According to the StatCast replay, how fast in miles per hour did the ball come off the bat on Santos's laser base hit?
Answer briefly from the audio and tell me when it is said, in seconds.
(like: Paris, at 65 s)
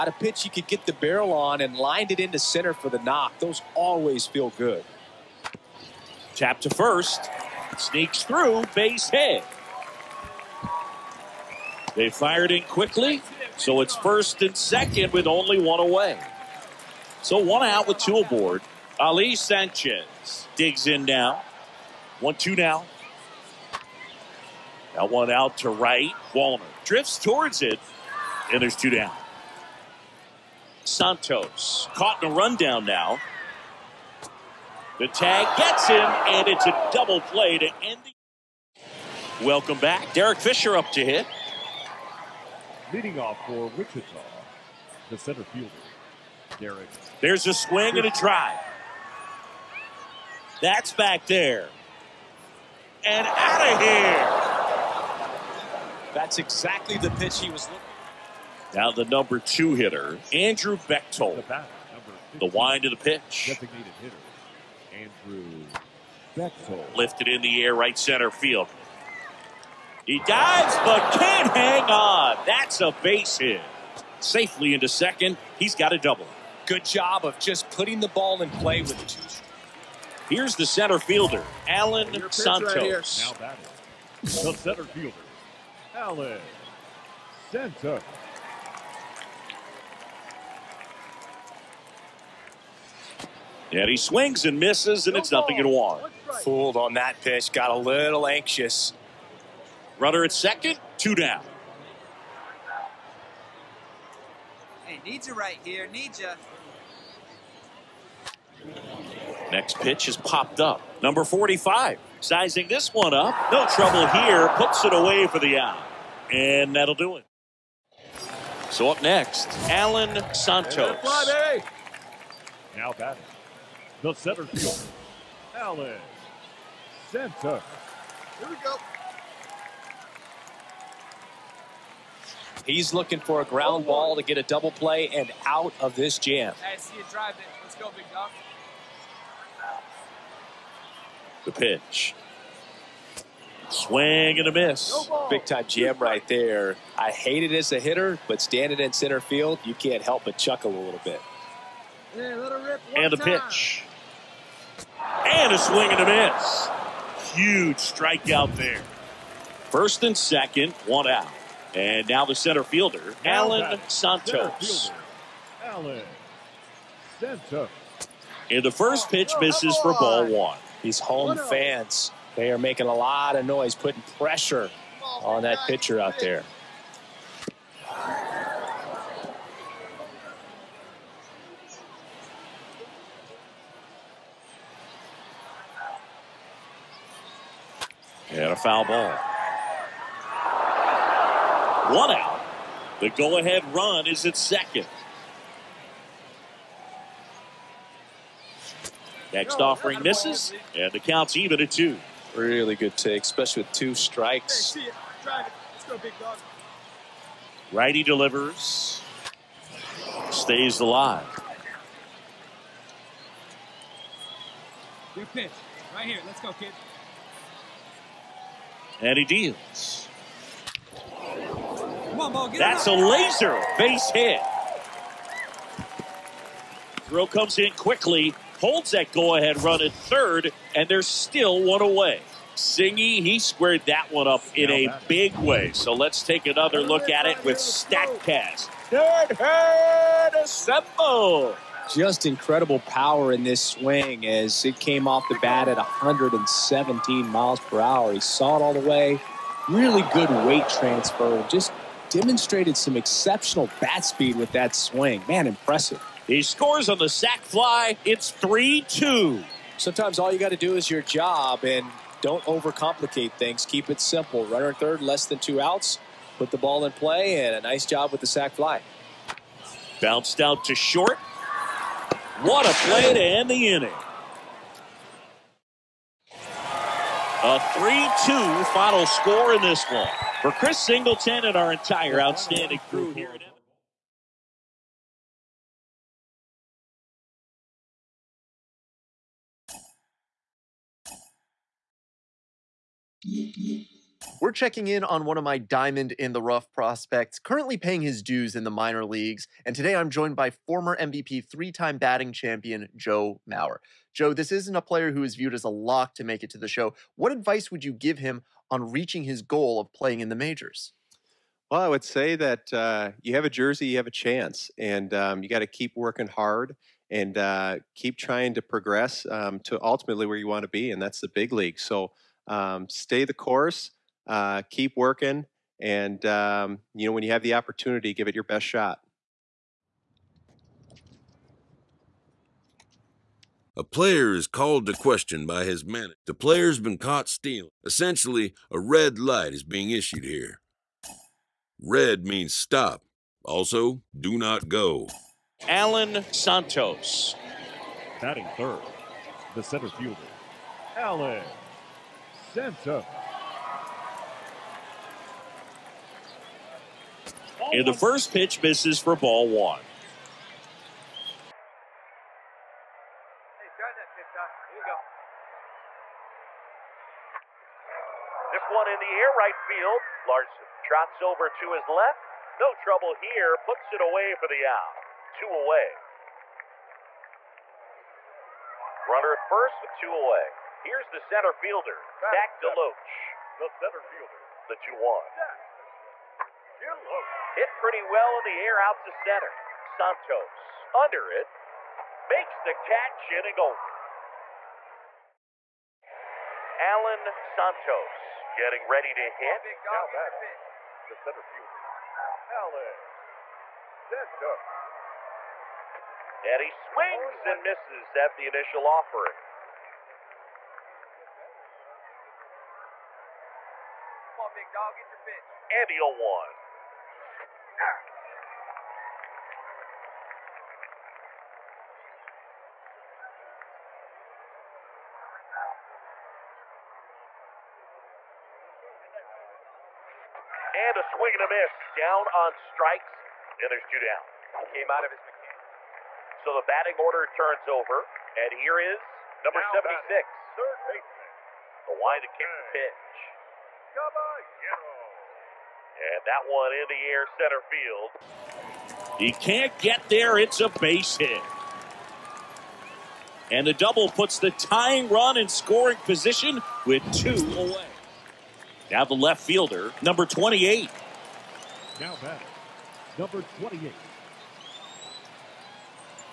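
117, at 245 s.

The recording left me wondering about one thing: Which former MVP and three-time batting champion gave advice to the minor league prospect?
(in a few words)
Joe Mauer.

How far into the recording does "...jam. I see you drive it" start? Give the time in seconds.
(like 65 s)
136 s.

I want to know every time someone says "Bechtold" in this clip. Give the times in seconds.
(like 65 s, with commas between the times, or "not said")
60 s, 66 s.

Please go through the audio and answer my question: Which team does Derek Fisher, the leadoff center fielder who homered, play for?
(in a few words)
Wichita.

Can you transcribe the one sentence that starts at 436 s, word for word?
So the batting order turns over.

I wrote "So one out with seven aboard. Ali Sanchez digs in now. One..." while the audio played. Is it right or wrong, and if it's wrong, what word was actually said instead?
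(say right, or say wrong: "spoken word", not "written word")
wrong: "two", not "seven".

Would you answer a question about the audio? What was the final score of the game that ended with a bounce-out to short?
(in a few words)
3-2.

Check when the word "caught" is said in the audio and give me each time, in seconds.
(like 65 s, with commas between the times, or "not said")
31 s, 336 s.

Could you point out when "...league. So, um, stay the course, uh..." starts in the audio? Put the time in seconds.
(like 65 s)
321 s.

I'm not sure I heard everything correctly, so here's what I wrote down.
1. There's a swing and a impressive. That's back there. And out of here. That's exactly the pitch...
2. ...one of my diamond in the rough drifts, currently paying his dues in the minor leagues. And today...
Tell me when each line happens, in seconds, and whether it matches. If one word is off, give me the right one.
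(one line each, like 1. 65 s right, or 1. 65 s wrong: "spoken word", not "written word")
1. 47 s wrong: "drive", not "impressive"
2. 295 s wrong: "prospects", not "drifts".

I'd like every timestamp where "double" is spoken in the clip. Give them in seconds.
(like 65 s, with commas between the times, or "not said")
36 s, 75 s, 134 s, 453 s.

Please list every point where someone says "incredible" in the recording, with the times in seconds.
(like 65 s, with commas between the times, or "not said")
242 s.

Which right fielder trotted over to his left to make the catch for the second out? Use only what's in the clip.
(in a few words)
Larson.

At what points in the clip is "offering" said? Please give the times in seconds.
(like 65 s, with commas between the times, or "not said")
199 s, 408 s.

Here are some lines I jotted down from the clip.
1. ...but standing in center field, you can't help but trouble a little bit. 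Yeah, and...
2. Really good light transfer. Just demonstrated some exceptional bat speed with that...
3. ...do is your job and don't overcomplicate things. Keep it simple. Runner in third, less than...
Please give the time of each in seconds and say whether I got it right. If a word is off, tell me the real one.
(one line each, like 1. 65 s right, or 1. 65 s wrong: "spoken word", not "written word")
1. 148 s wrong: "chuckle", not "trouble"
2. 249 s wrong: "weight", not "light"
3. 260 s right.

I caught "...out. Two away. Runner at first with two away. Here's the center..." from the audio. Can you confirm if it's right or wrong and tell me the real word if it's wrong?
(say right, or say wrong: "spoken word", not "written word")
right.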